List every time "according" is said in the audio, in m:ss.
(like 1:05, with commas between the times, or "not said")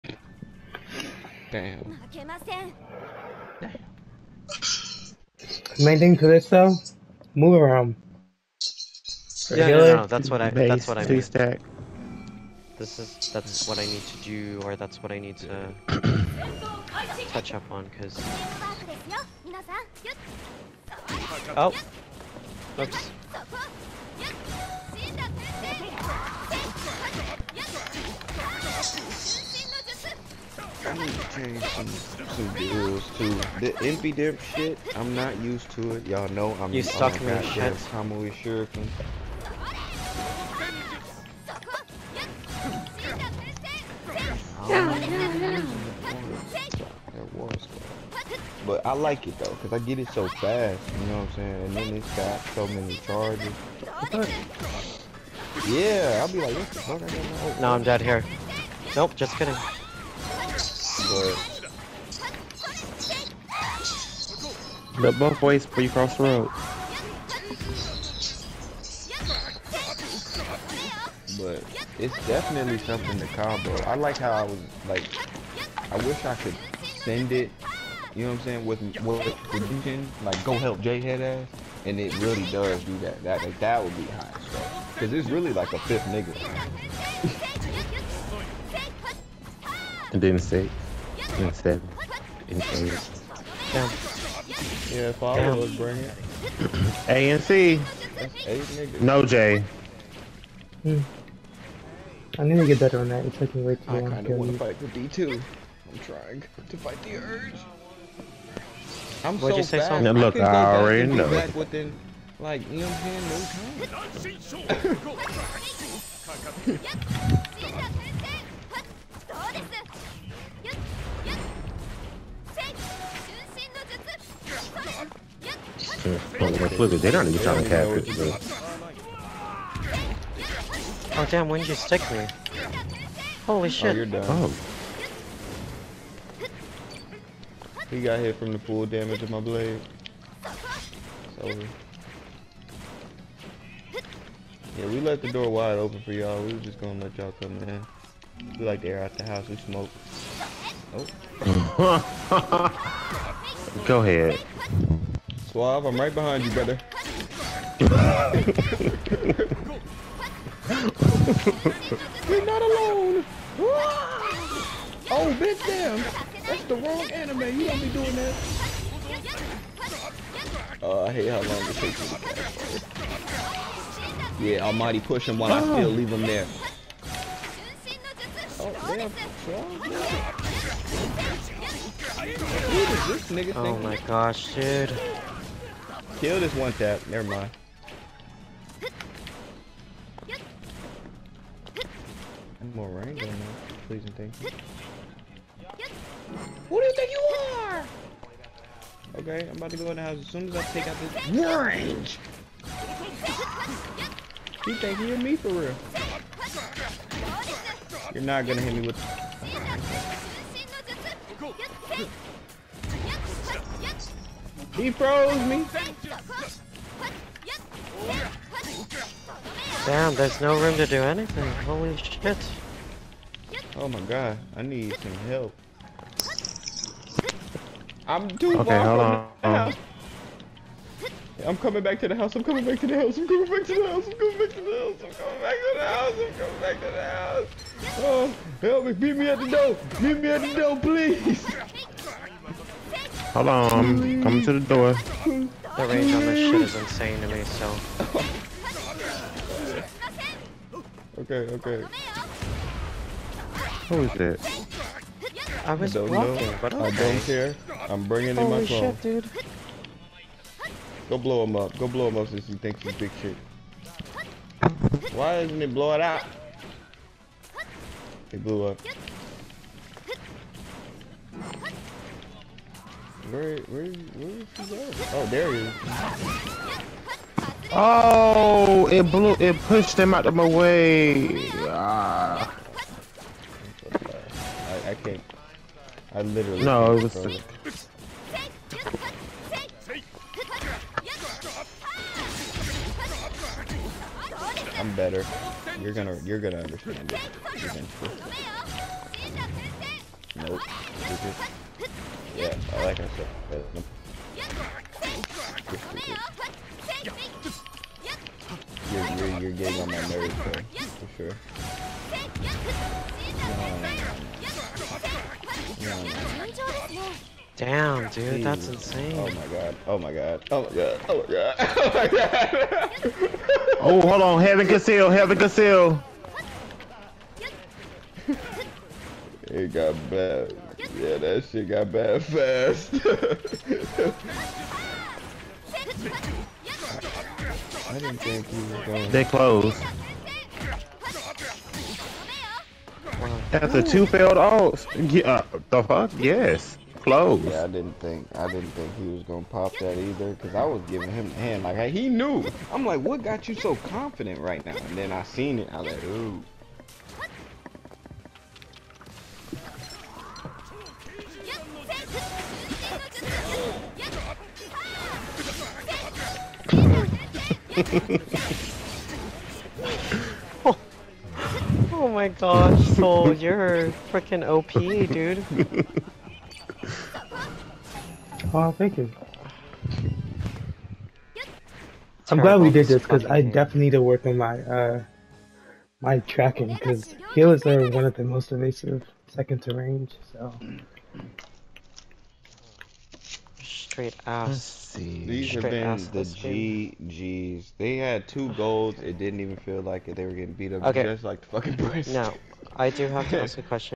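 not said.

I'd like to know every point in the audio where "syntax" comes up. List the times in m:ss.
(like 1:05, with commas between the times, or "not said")
not said.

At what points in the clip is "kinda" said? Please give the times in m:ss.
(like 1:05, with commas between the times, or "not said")
1:44.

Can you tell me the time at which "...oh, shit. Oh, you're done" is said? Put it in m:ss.
2:13.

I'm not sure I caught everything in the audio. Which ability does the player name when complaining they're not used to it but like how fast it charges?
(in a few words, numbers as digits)
Kamui Shuriken.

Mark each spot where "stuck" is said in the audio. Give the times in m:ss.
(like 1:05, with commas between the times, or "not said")
0:36.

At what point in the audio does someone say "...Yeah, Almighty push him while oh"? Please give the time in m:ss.
2:54.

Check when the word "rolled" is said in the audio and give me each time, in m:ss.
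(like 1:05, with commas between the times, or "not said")
not said.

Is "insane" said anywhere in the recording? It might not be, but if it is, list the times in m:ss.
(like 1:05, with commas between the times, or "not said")
4:06, 5:18.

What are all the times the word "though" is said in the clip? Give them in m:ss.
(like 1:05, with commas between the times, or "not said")
0:06, 0:49.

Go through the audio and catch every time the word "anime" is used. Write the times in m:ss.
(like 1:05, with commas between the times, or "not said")
2:47.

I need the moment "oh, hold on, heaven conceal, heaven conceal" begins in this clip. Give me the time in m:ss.
5:23.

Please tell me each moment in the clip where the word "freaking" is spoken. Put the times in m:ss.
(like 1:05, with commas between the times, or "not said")
6:14.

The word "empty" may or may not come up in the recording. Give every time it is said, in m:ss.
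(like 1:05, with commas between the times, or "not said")
0:33.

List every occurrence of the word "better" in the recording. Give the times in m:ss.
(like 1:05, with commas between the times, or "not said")
1:42, 4:54.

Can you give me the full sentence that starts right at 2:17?
He got hit from the full damage of my blade.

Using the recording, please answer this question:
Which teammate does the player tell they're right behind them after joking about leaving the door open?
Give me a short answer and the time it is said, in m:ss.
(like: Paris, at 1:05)
Suave, at 2:35.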